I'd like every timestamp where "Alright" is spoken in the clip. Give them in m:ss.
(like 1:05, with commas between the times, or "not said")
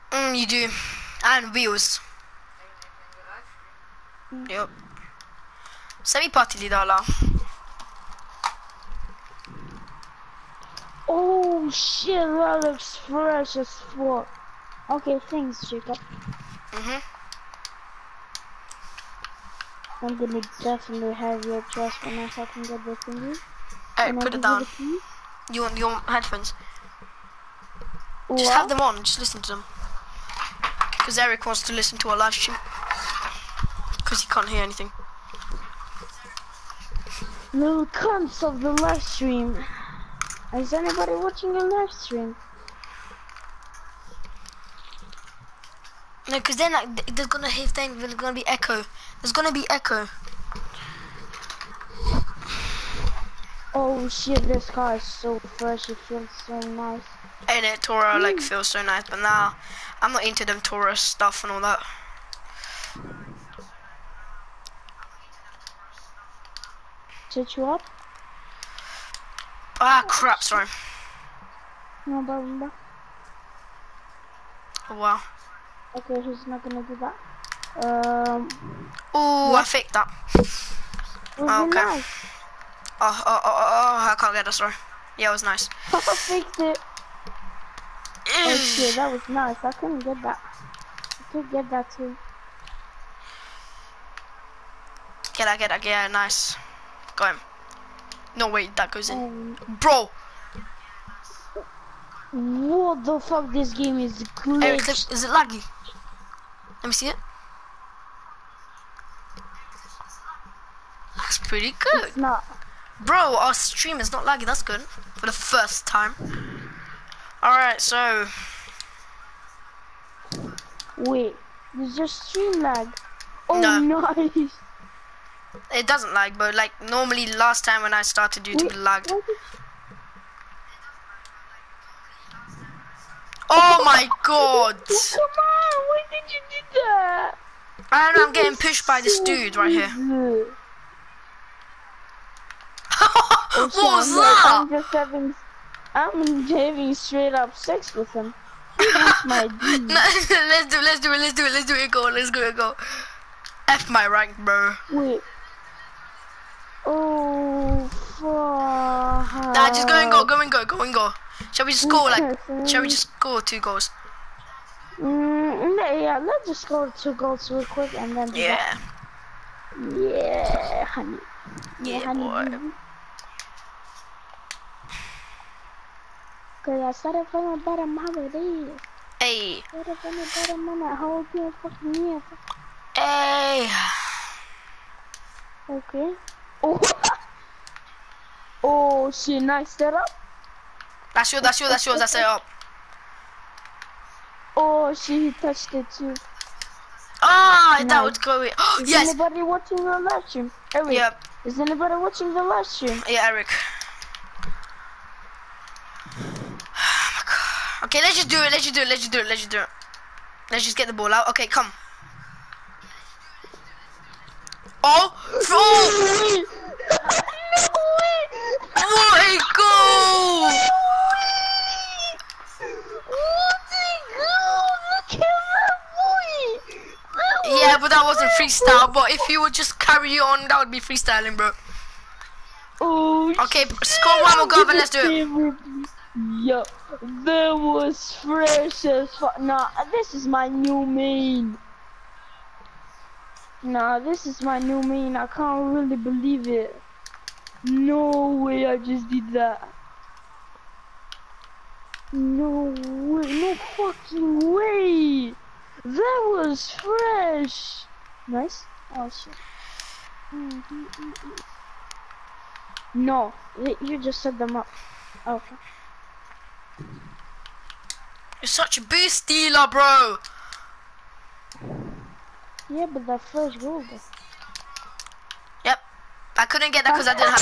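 0:23, 1:57.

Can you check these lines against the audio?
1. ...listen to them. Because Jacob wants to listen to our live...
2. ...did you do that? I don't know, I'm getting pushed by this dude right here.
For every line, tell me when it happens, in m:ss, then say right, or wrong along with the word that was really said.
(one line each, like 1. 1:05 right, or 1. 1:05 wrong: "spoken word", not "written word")
1. 0:29 wrong: "Eric", not "Jacob"
2. 2:16 right.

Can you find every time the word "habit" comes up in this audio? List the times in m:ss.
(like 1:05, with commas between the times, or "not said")
not said.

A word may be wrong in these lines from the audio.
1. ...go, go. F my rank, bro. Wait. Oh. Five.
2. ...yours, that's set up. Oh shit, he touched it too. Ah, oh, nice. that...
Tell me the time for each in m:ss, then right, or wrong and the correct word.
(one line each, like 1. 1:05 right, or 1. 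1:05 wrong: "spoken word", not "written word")
1. 2:32 wrong: "Four", not "Five"
2. 3:11 right.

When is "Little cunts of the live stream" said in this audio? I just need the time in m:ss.
0:37.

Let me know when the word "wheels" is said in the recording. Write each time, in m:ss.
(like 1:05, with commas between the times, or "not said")
0:01.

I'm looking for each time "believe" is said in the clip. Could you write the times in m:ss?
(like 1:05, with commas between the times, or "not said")
4:05.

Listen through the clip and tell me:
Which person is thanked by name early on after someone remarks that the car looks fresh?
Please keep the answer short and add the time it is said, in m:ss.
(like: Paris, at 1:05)
Jacob, at 0:15.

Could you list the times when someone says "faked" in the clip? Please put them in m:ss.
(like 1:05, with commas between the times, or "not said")
1:19, 1:26.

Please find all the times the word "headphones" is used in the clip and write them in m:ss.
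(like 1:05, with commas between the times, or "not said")
0:26.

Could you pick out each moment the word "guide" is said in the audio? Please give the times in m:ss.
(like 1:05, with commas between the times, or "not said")
not said.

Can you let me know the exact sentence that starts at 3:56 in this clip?
Yo, that was fresh as fuck.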